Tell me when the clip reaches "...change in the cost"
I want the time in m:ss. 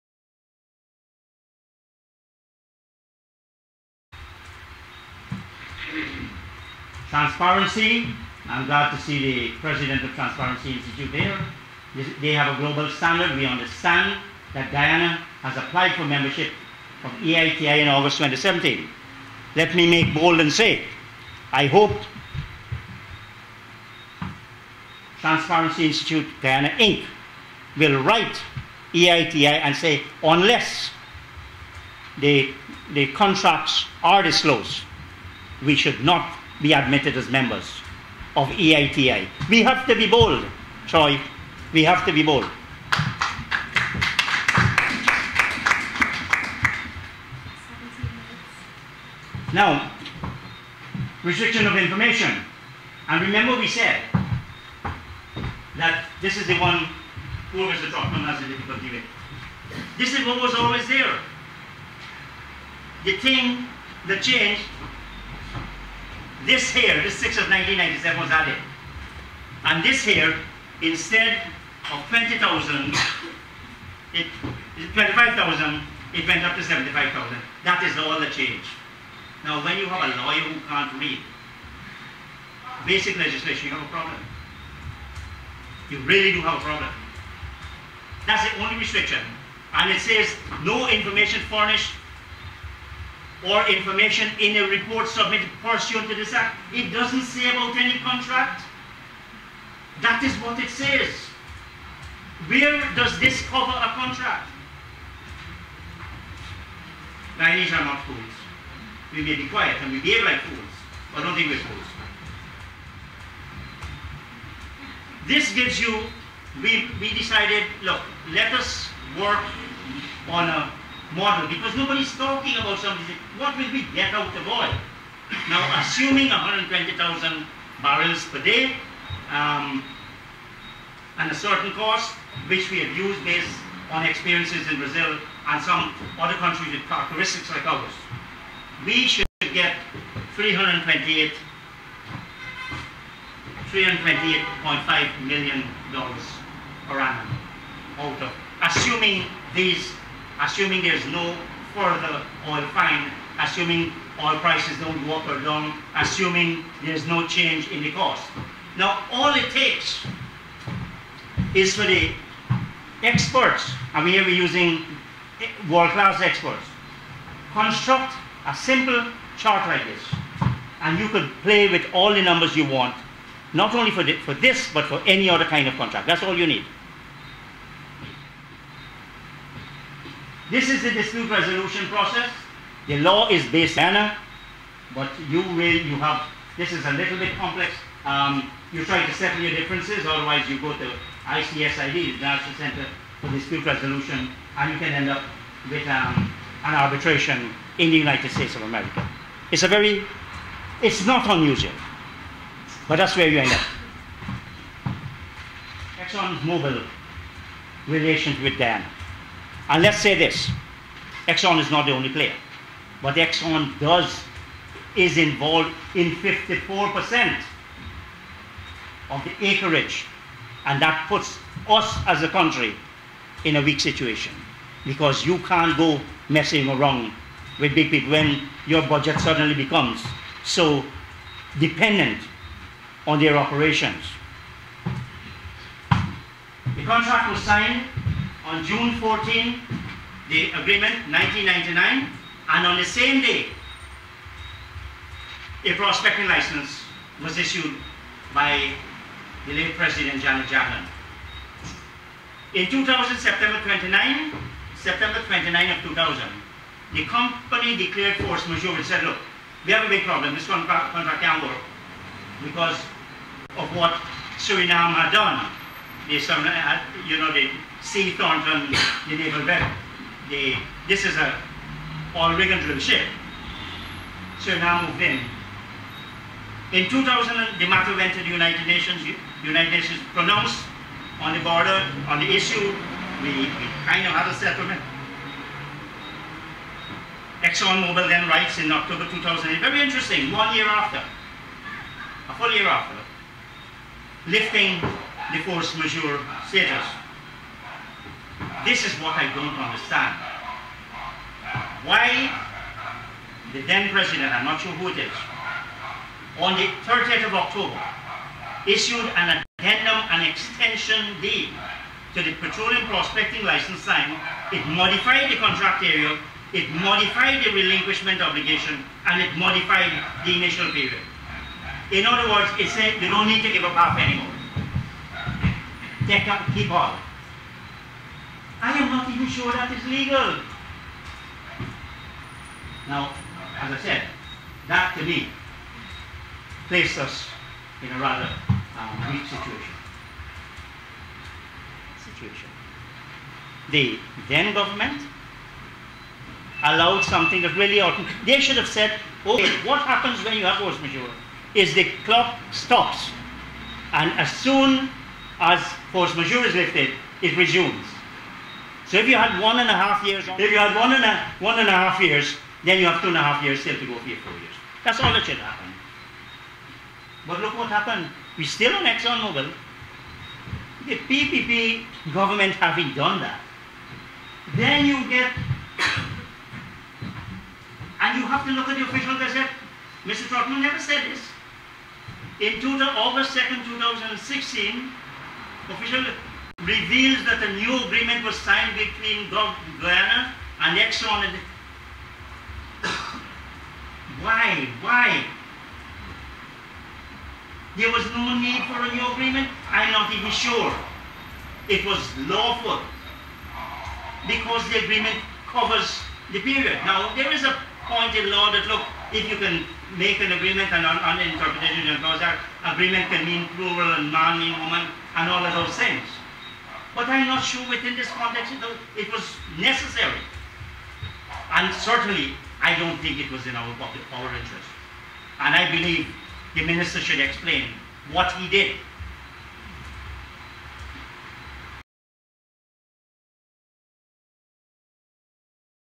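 2:37.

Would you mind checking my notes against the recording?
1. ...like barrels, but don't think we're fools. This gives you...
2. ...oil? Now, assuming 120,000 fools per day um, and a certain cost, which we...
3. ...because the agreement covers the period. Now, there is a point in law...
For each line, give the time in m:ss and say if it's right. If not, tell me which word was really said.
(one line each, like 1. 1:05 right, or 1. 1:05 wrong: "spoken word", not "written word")
1. 1:50 wrong: "fools", not "barrels"
2. 2:04 wrong: "barrels", not "fools"
3. 6:44 right.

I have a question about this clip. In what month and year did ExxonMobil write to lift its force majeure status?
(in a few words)
October 2008.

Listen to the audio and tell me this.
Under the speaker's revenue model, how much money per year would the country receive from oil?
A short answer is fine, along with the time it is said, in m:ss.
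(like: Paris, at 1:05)
$328.5 million, at 2:23.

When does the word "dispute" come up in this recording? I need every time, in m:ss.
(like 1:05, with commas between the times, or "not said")
3:00, 3:13.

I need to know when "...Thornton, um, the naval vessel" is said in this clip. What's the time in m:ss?
4:28.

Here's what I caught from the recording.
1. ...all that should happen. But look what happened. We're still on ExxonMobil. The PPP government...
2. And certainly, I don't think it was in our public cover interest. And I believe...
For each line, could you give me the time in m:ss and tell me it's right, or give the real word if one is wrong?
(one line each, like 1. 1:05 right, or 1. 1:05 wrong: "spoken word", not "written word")
1. 6:04 right
2. 7:01 wrong: "power", not "cover".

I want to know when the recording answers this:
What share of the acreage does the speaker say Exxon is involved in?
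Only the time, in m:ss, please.
3:36.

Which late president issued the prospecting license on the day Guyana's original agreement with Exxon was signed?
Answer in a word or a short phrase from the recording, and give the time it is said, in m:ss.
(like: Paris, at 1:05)
Janet Jagan, at 4:10.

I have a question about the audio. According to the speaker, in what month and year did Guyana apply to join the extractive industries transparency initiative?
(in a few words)
August 2017.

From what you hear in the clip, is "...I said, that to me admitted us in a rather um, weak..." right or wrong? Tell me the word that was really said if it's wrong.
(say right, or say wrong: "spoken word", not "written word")
wrong: "placed", not "admitted".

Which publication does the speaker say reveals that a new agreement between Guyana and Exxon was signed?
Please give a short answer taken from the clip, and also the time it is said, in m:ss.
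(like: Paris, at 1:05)
official gazette, at 6:18.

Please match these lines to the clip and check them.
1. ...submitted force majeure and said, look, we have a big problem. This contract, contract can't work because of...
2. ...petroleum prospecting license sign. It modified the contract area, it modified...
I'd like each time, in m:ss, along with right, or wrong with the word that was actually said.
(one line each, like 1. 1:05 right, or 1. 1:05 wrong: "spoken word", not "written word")
1. 4:17 wrong: "declared", not "submitted"
2. 5:12 right.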